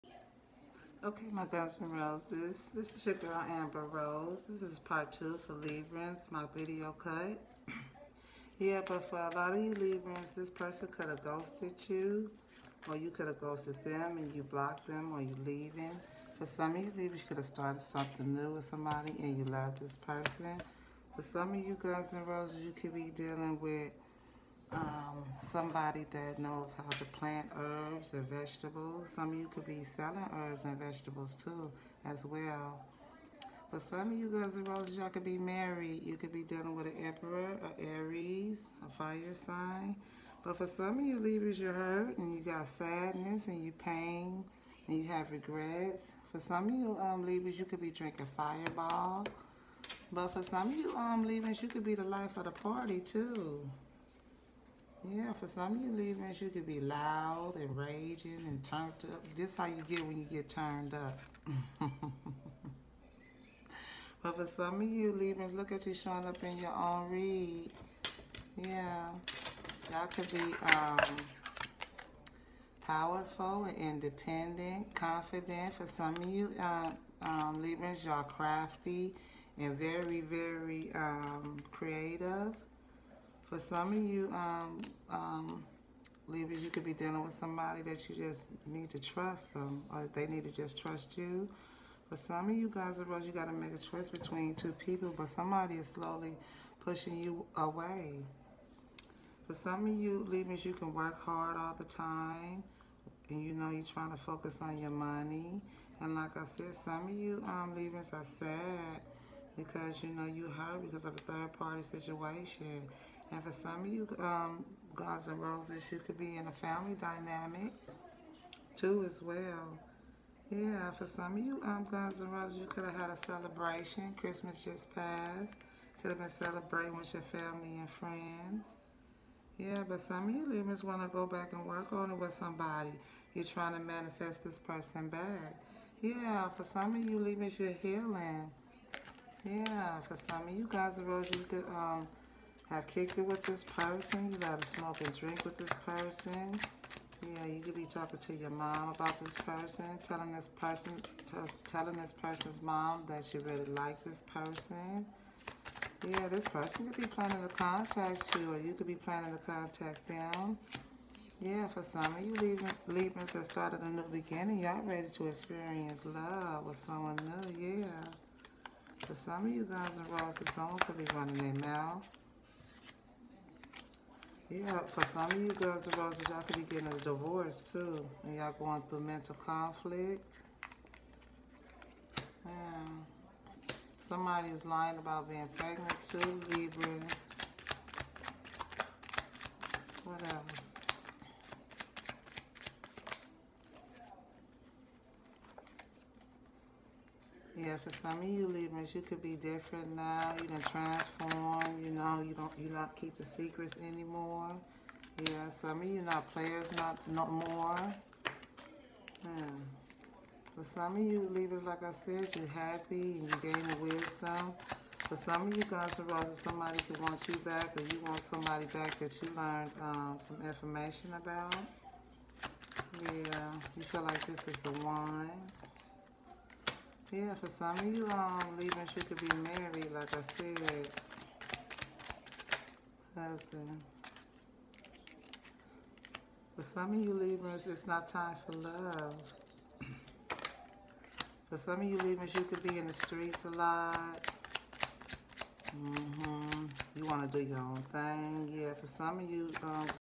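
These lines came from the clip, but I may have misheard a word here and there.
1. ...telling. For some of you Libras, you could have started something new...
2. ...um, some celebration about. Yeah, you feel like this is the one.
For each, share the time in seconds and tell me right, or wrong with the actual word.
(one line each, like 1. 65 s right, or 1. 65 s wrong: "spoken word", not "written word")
1. 15 s wrong: "leaving", not "telling"
2. 219 s wrong: "information", not "celebration".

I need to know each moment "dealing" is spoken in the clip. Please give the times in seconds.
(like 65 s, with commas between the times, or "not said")
23 s, 36 s, 86 s.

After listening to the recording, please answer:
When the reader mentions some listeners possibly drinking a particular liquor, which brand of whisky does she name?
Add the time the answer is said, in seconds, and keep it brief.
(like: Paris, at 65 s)
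Fireball, at 48 s.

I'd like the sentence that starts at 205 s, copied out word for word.
Yeah, some of you not players not not more.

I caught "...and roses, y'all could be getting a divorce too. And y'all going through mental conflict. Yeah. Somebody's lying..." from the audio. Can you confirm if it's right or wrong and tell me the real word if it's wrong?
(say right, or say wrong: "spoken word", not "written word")
right.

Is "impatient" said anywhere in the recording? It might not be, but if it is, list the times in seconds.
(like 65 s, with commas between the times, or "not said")
not said.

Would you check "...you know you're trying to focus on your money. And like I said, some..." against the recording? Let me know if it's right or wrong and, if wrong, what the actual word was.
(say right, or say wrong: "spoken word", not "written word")
right.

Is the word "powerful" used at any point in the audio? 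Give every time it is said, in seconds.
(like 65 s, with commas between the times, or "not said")
72 s.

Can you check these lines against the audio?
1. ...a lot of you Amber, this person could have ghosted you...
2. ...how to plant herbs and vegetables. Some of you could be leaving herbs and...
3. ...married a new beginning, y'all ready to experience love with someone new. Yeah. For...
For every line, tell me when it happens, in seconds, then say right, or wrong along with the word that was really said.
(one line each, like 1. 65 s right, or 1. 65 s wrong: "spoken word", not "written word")
1. 9 s wrong: "Librans", not "Amber"
2. 26 s wrong: "selling", not "leaving"
3. 163 s wrong: "started", not "married".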